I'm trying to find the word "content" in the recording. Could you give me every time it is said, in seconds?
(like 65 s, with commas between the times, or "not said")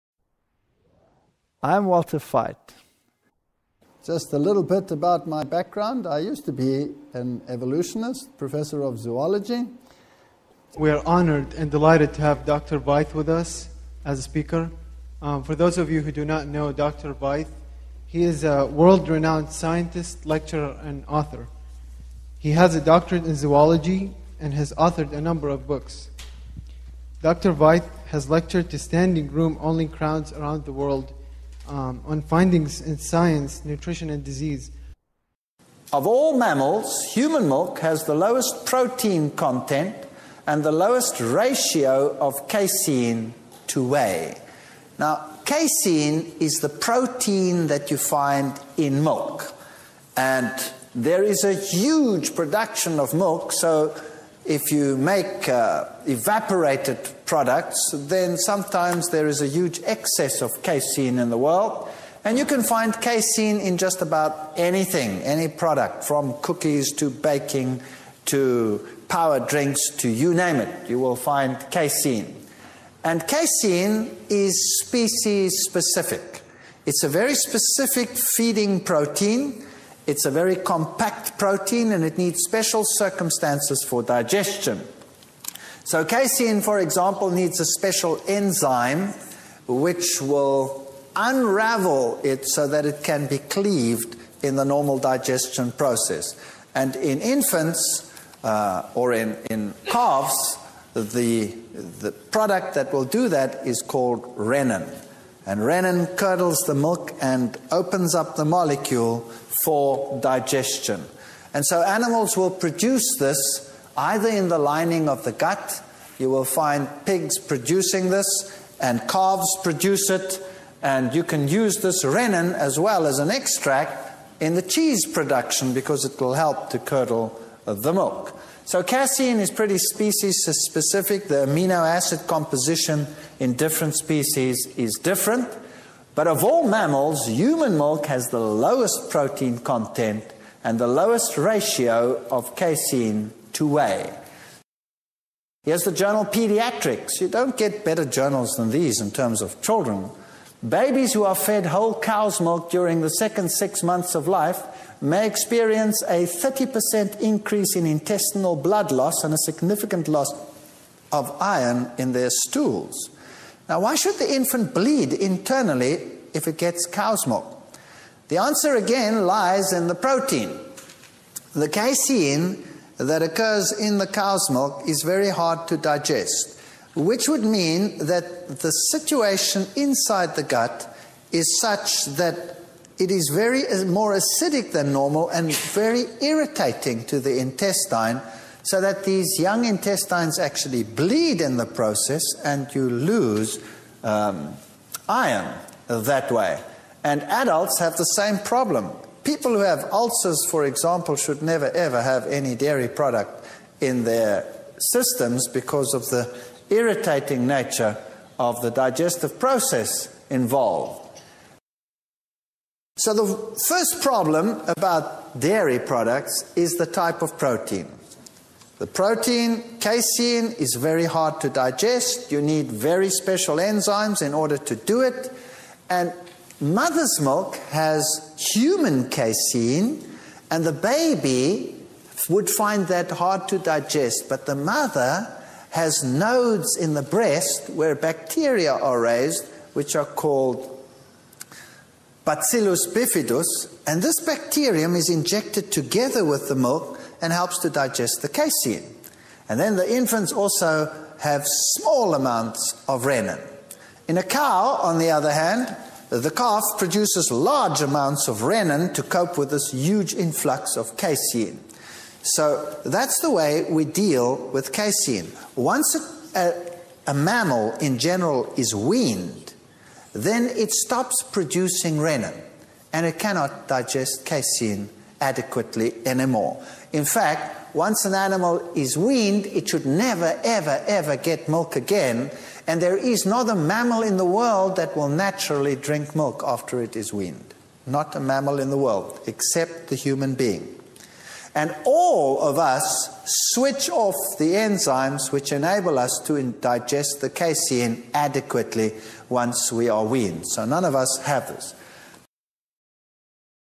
39 s, 139 s.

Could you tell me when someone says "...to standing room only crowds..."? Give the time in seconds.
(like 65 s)
28 s.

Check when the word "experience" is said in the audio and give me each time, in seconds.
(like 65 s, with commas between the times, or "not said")
155 s.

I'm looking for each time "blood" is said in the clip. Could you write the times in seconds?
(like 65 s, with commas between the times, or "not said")
158 s.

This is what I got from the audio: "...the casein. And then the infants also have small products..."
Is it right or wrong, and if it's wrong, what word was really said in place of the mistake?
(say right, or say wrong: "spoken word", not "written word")
wrong: "amounts", not "products".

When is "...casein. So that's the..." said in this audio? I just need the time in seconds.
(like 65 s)
260 s.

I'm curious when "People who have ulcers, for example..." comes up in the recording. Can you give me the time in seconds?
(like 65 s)
199 s.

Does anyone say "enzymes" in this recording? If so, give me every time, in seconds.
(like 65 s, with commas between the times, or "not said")
88 s, 223 s, 294 s.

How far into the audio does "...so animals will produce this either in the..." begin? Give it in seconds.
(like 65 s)
111 s.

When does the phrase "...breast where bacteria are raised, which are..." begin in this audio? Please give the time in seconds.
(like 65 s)
237 s.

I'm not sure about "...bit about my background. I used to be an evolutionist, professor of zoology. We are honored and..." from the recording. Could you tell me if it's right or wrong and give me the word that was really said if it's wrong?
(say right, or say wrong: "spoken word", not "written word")
right.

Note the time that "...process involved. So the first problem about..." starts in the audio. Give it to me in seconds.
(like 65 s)
209 s.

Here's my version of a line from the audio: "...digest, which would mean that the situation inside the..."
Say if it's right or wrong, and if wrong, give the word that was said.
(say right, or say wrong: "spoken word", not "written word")
right.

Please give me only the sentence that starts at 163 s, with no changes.
Now, why should the infant bleed internally if it gets cow's milk?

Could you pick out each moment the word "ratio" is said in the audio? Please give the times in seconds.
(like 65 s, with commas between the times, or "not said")
41 s, 141 s.